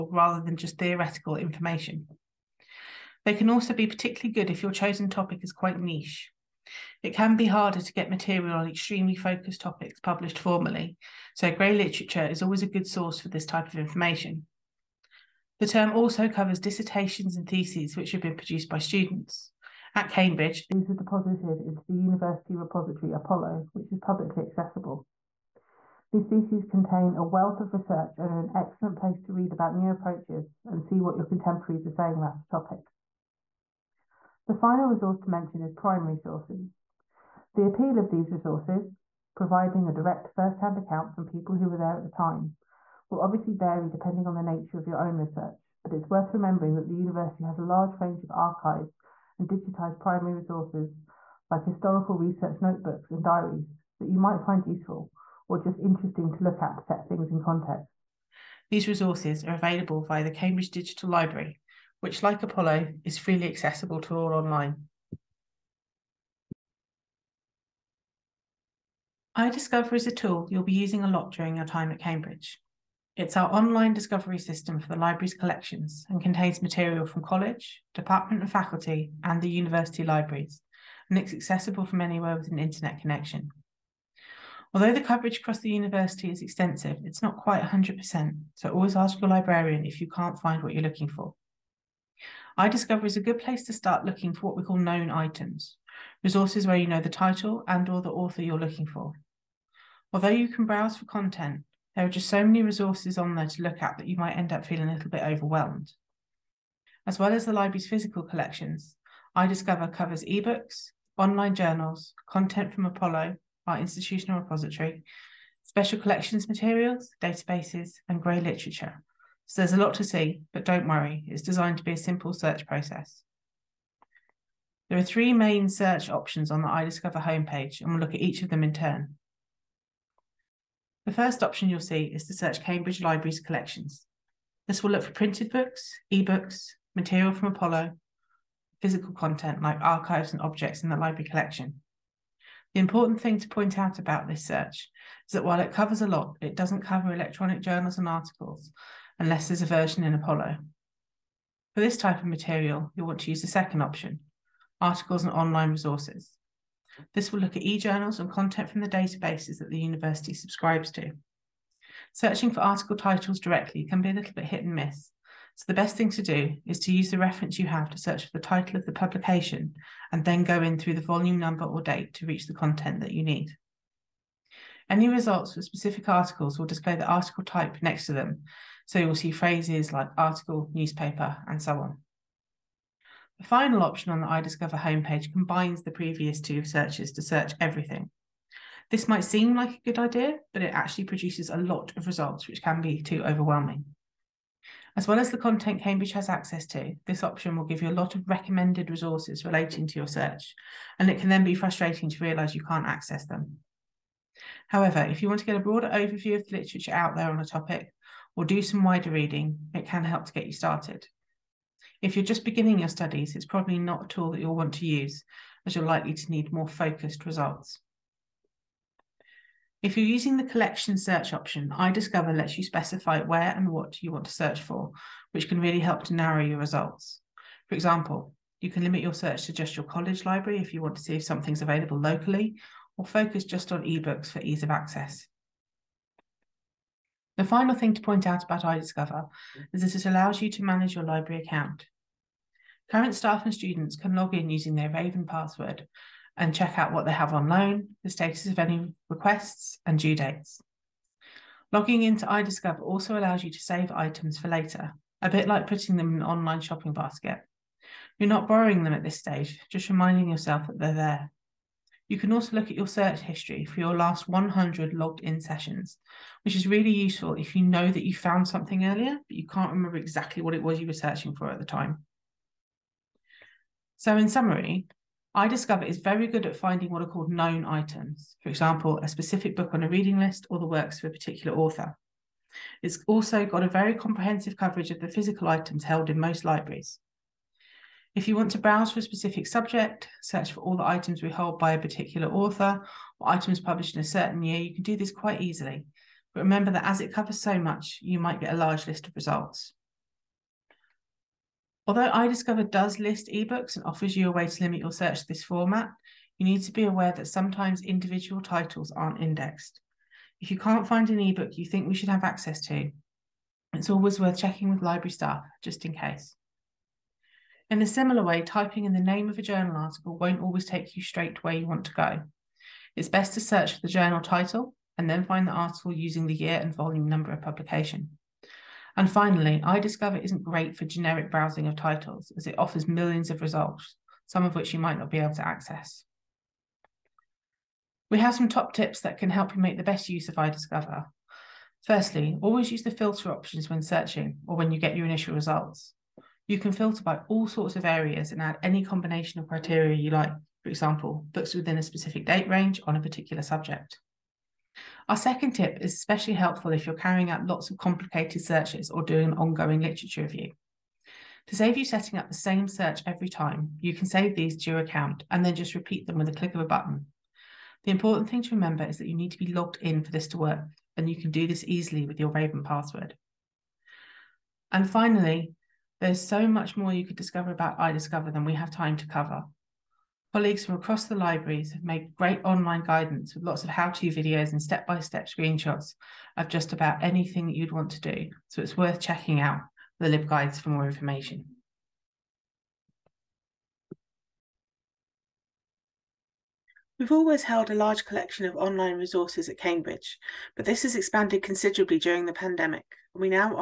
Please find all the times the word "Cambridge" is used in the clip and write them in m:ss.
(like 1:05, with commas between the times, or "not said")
0:20, 1:00, 1:11, 2:12, 3:15, 6:39.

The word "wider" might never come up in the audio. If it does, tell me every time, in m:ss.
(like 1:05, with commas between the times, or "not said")
3:28.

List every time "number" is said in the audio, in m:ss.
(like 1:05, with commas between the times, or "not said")
2:51, 5:27.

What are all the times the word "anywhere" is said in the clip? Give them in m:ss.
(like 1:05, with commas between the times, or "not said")
1:21.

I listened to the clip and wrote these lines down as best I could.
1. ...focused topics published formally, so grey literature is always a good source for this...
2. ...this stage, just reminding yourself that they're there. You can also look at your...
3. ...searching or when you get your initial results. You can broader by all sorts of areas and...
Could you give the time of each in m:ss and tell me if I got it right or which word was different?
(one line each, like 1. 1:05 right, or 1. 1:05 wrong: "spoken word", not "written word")
1. 0:09 right
2. 4:19 right
3. 5:43 wrong: "filter", not "broader".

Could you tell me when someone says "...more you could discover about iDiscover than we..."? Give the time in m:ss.
6:16.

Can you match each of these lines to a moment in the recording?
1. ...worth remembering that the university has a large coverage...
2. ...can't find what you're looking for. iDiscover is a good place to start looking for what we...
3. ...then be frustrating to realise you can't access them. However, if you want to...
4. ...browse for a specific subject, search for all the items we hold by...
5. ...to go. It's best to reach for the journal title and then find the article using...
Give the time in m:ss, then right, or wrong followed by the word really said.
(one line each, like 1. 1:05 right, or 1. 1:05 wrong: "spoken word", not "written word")
1. 0:46 wrong: "range", not "coverage"
2. 1:30 right
3. 3:21 right
4. 4:48 right
5. 5:21 wrong: "search", not "reach".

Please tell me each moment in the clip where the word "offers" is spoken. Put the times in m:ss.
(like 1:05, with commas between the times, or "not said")
5:03, 5:32.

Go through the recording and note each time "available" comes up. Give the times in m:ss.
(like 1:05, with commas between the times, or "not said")
0:59, 3:51.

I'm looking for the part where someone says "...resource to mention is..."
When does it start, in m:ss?
0:34.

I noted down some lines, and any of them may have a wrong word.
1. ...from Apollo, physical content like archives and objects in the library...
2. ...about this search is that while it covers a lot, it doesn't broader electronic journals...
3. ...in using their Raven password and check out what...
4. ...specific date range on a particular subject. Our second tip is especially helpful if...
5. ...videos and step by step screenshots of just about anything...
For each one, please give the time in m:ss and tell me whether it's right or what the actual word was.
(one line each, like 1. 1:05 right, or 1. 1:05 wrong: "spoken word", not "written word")
1. 2:17 right
2. 2:23 wrong: "cover", not "broader"
3. 4:04 right
4. 5:51 right
5. 6:24 right.